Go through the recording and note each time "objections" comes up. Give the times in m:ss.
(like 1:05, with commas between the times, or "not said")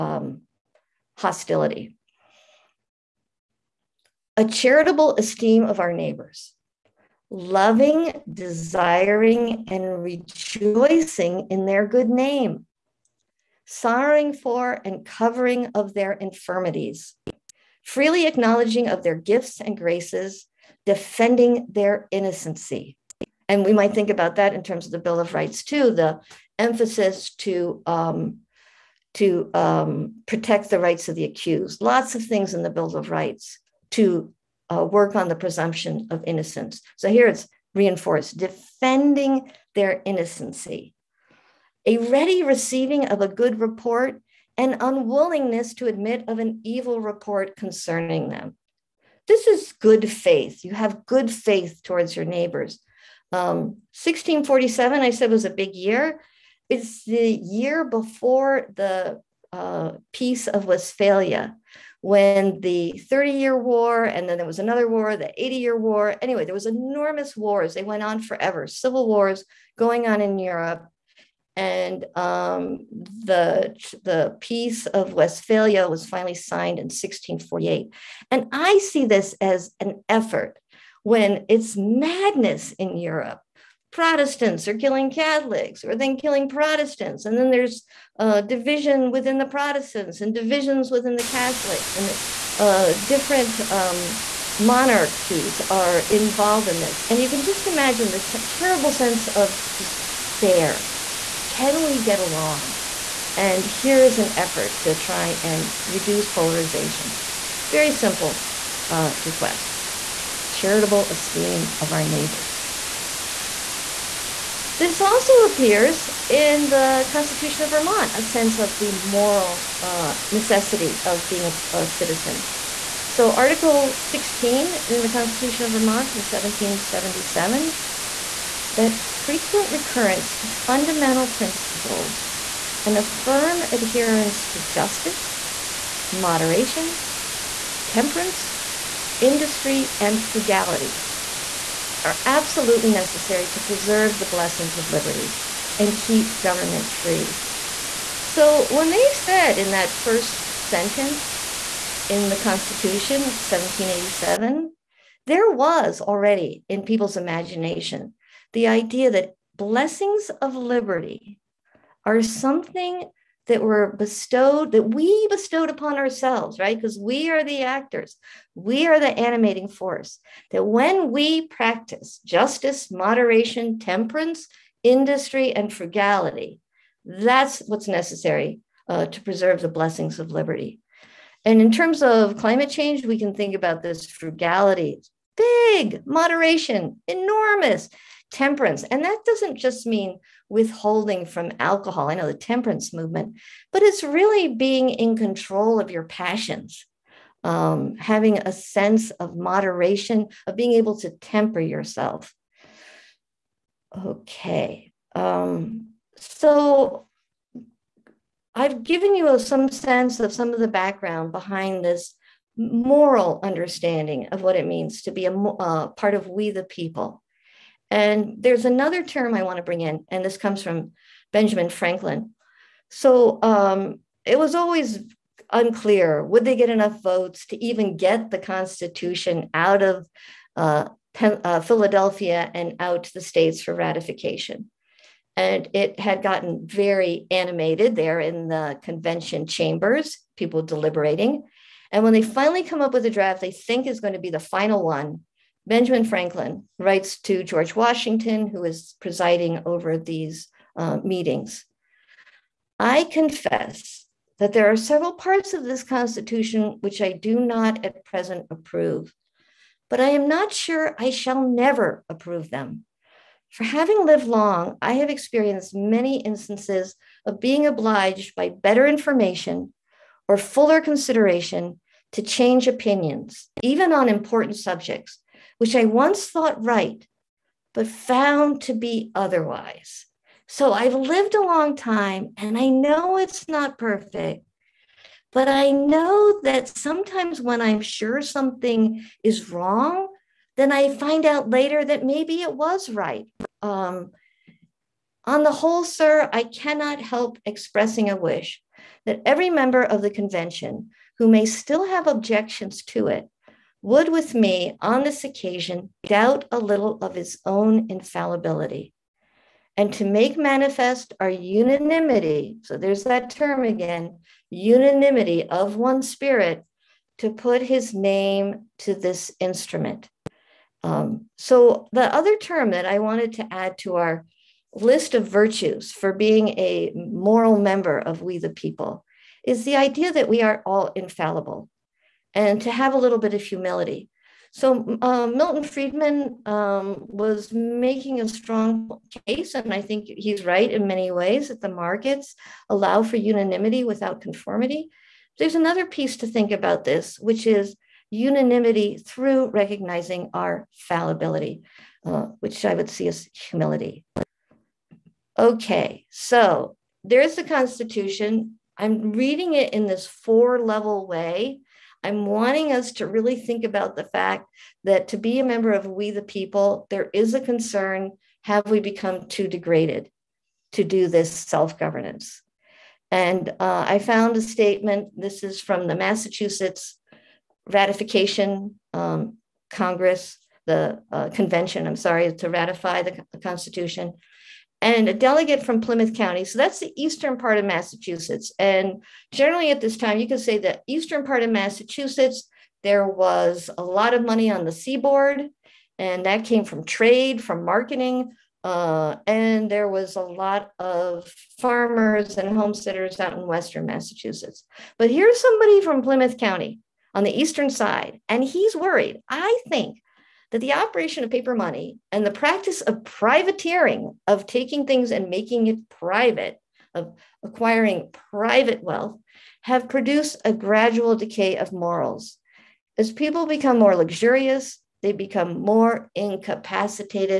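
5:02.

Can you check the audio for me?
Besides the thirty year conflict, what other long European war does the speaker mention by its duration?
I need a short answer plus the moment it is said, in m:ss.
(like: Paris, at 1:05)
the 80 year war, at 1:05.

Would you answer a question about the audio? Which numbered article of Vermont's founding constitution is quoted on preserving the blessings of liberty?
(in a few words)
Article 16.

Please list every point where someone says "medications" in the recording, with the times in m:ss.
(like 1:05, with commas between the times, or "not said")
not said.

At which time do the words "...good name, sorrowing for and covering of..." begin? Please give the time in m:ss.
0:11.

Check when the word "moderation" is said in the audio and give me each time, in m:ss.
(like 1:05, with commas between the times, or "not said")
2:16, 2:52, 3:06, 3:19.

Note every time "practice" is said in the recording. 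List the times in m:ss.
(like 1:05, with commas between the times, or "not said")
2:51, 6:52.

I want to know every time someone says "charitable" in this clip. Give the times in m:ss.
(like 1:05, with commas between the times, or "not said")
0:04, 1:50.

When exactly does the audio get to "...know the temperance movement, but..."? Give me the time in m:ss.
3:12.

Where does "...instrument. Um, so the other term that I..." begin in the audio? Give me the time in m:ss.
5:19.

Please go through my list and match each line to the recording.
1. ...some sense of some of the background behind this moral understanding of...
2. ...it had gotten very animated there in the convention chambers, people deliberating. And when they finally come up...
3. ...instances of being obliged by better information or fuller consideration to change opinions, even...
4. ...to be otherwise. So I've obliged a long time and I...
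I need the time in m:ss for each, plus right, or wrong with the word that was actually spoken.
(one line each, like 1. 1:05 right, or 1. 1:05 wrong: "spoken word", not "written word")
1. 3:29 right
2. 3:55 right
3. 4:26 right
4. 4:38 wrong: "lived", not "obliged".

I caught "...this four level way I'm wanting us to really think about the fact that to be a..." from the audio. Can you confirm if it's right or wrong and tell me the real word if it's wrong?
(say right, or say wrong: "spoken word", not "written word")
right.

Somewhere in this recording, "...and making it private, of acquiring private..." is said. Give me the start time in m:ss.
6:55.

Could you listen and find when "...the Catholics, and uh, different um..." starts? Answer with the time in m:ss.
1:31.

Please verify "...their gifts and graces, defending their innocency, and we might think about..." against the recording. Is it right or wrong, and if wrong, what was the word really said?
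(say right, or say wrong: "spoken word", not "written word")
right.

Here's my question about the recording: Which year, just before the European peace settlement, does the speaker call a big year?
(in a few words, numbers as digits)
1647.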